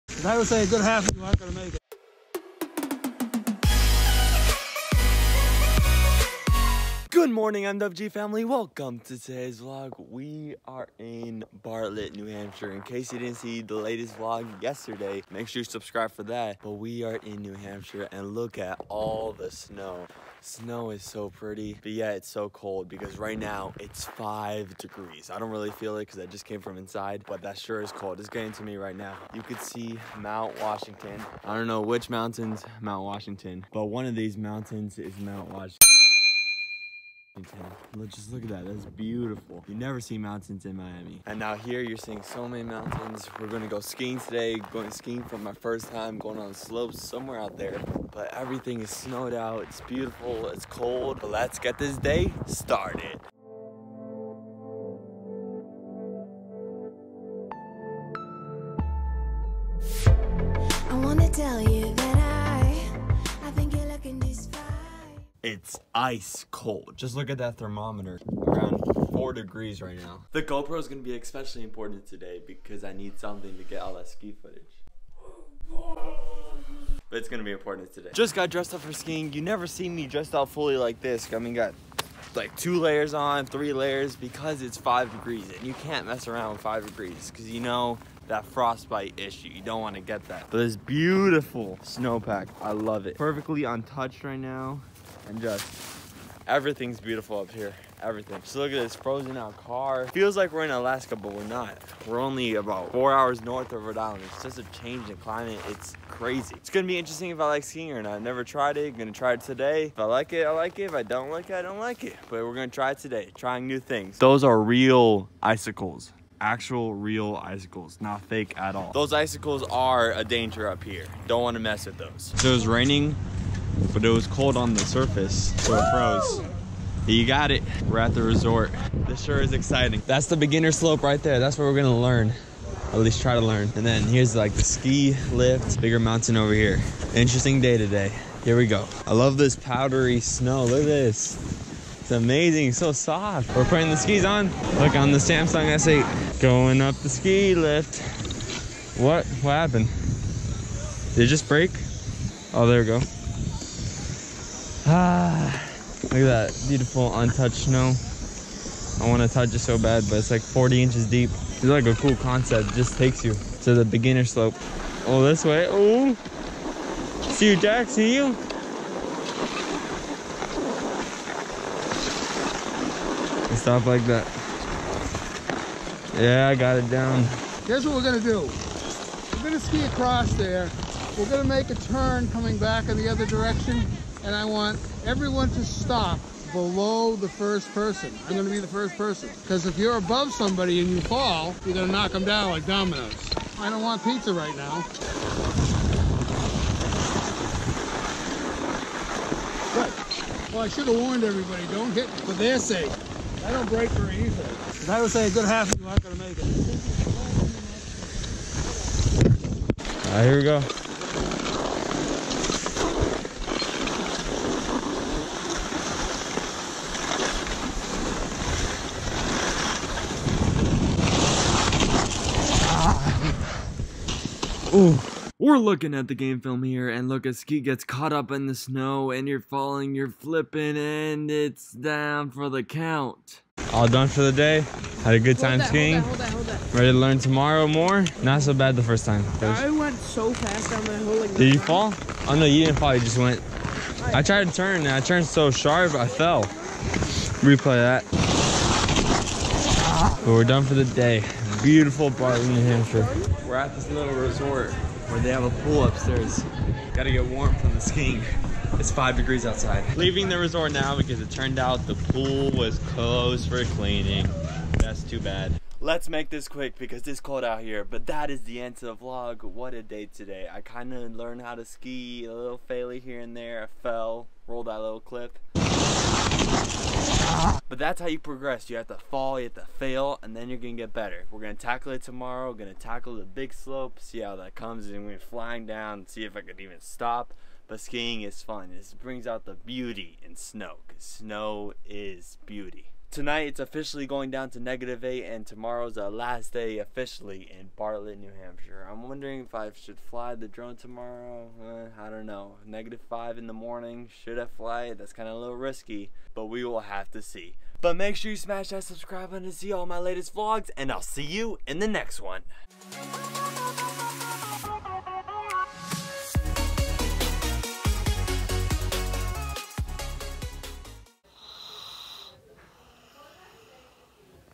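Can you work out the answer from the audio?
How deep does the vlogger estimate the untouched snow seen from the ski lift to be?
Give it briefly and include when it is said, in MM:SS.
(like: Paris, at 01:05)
40 inches, at 02:40.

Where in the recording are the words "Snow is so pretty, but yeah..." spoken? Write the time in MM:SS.
00:20.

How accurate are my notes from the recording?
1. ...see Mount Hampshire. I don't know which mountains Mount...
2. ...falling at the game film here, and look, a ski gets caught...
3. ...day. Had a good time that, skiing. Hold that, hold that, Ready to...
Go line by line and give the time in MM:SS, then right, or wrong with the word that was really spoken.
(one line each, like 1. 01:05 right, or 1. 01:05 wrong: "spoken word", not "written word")
1. 00:29 wrong: "Washington", not "Hampshire"
2. 03:45 wrong: "looking", not "falling"
3. 03:54 right.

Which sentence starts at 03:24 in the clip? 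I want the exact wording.
Because I would say a good half of you aren't gonna make it.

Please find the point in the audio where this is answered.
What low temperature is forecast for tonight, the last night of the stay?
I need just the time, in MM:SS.
04:54.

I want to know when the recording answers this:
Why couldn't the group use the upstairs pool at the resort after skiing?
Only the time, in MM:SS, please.
04:22.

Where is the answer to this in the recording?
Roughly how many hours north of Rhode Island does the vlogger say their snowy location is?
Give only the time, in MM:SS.
01:42.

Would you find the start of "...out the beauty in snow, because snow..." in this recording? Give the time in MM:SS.
04:49.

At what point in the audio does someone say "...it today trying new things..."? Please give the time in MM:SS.
01:52.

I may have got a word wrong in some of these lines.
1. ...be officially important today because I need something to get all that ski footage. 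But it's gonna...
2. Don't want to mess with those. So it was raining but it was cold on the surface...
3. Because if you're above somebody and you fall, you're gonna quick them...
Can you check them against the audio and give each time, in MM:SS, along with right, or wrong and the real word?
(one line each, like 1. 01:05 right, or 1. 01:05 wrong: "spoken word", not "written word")
1. 01:11 wrong: "especially", not "officially"
2. 02:01 right
3. 03:09 wrong: "knock", not "quick".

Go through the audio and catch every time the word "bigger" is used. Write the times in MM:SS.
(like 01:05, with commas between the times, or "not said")
02:15.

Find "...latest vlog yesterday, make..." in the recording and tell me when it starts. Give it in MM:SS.
00:13.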